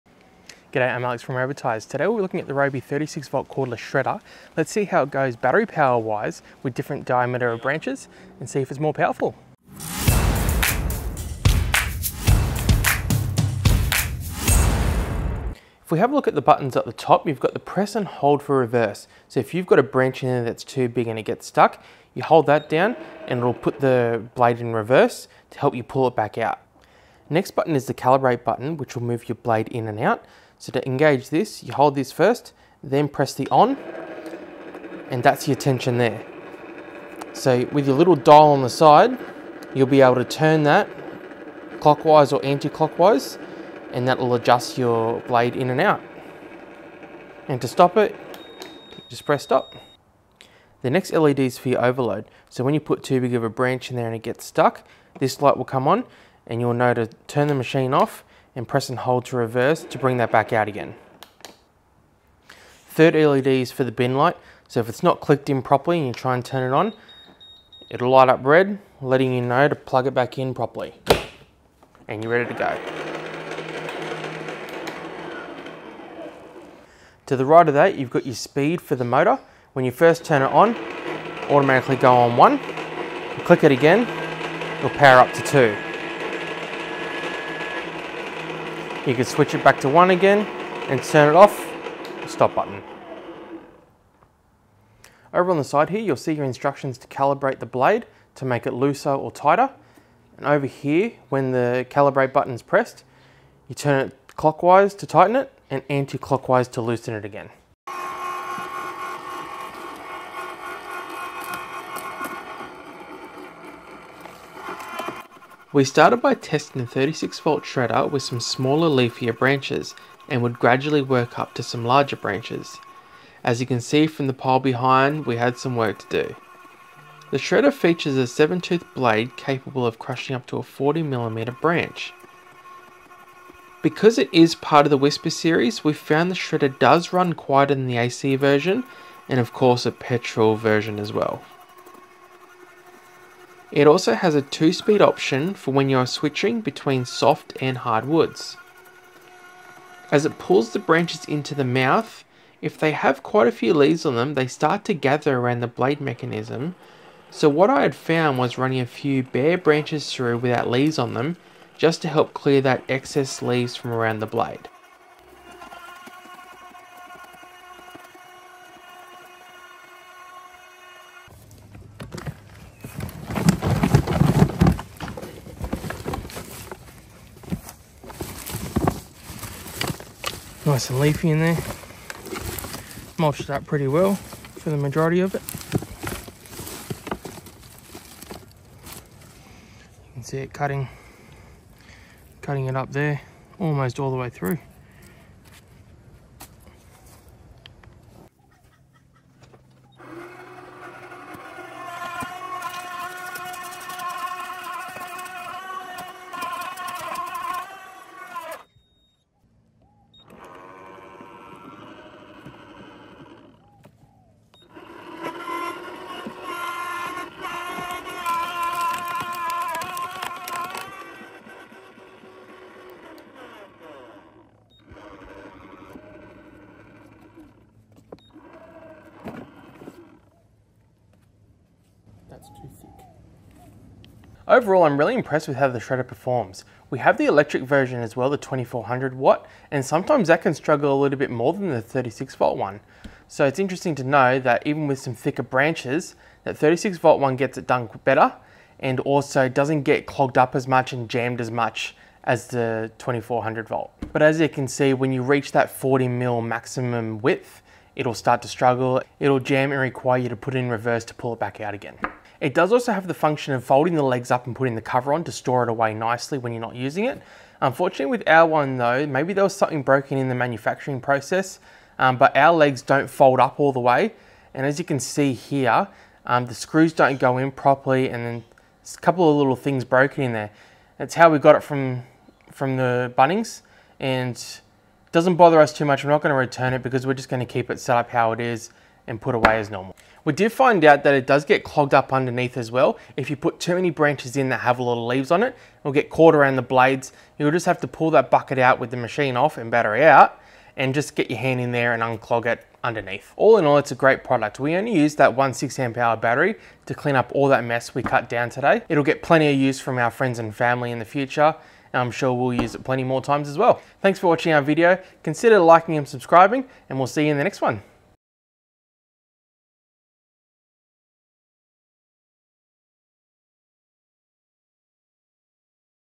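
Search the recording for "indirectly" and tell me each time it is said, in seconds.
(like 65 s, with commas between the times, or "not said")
not said.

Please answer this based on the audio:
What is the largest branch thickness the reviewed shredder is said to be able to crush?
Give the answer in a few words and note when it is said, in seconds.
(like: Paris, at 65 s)
40mm, at 130 s.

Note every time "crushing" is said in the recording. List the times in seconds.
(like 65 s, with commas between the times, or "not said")
129 s.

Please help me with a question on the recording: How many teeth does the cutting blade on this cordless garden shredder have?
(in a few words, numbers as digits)
7.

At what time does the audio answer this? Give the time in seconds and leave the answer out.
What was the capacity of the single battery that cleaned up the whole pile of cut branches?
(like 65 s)
305 s.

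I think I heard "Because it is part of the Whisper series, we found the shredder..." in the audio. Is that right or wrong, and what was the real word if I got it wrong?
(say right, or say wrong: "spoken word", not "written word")
right.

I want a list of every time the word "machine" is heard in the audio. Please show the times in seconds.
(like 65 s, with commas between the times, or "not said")
57 s, 298 s.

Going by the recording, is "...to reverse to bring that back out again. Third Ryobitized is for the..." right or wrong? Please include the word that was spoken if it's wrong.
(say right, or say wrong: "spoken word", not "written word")
wrong: "LED", not "Ryobitized".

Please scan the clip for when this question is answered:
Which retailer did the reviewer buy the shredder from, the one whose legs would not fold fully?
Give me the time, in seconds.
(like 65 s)
283 s.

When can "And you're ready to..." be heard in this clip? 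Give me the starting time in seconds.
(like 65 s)
72 s.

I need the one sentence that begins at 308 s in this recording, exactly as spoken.
It'll get plenty of use from our friends and family in the future.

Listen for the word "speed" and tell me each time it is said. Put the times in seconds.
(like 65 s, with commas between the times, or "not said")
78 s, 144 s.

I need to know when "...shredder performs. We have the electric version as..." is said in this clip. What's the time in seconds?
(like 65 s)
235 s.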